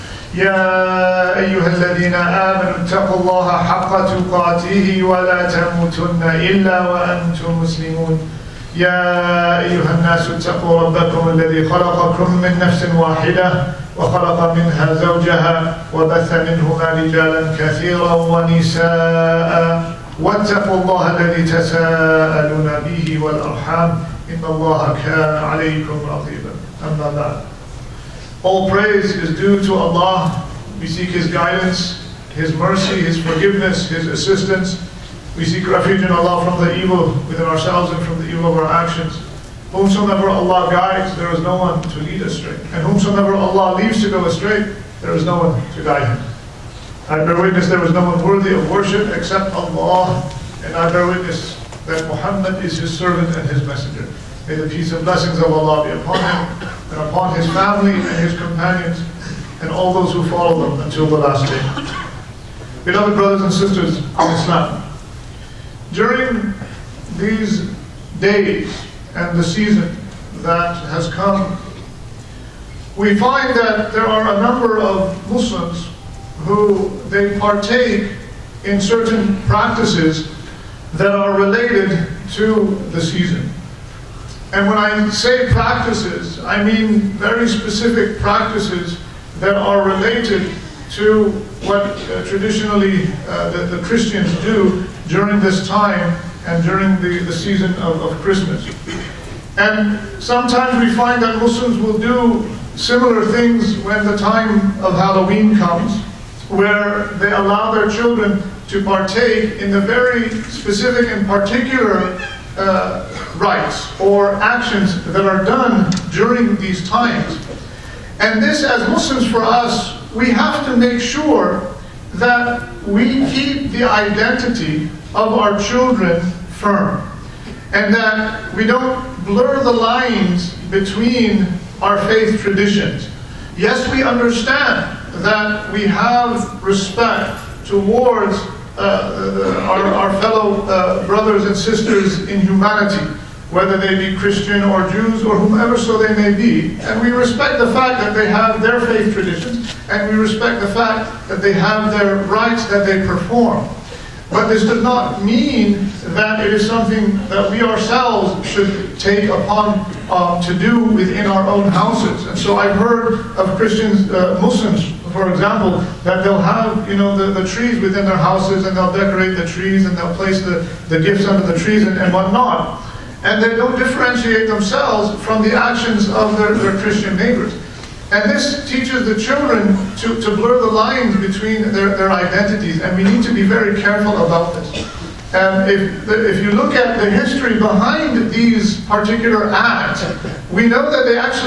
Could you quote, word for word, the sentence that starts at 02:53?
And they don't differentiate themselves from the actions of their, their Christian neighbors.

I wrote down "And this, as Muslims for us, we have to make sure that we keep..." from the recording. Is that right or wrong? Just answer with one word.
right.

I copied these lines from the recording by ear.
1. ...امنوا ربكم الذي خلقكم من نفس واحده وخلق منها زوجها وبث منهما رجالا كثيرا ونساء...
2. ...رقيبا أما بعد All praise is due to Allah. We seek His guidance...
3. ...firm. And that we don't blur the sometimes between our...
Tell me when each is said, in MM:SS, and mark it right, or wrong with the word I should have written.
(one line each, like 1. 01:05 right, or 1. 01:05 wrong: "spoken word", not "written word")
1. 00:10 wrong: "اتقوا", not "امنوا"
2. 00:26 right
3. 02:06 wrong: "lines", not "sometimes".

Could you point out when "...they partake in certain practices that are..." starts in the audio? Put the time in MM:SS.
01:17.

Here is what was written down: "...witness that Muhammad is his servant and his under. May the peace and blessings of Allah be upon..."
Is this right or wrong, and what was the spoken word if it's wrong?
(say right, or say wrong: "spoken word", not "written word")
wrong: "messenger", not "under".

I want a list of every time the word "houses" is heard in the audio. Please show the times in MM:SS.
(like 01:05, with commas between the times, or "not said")
02:41, 02:48.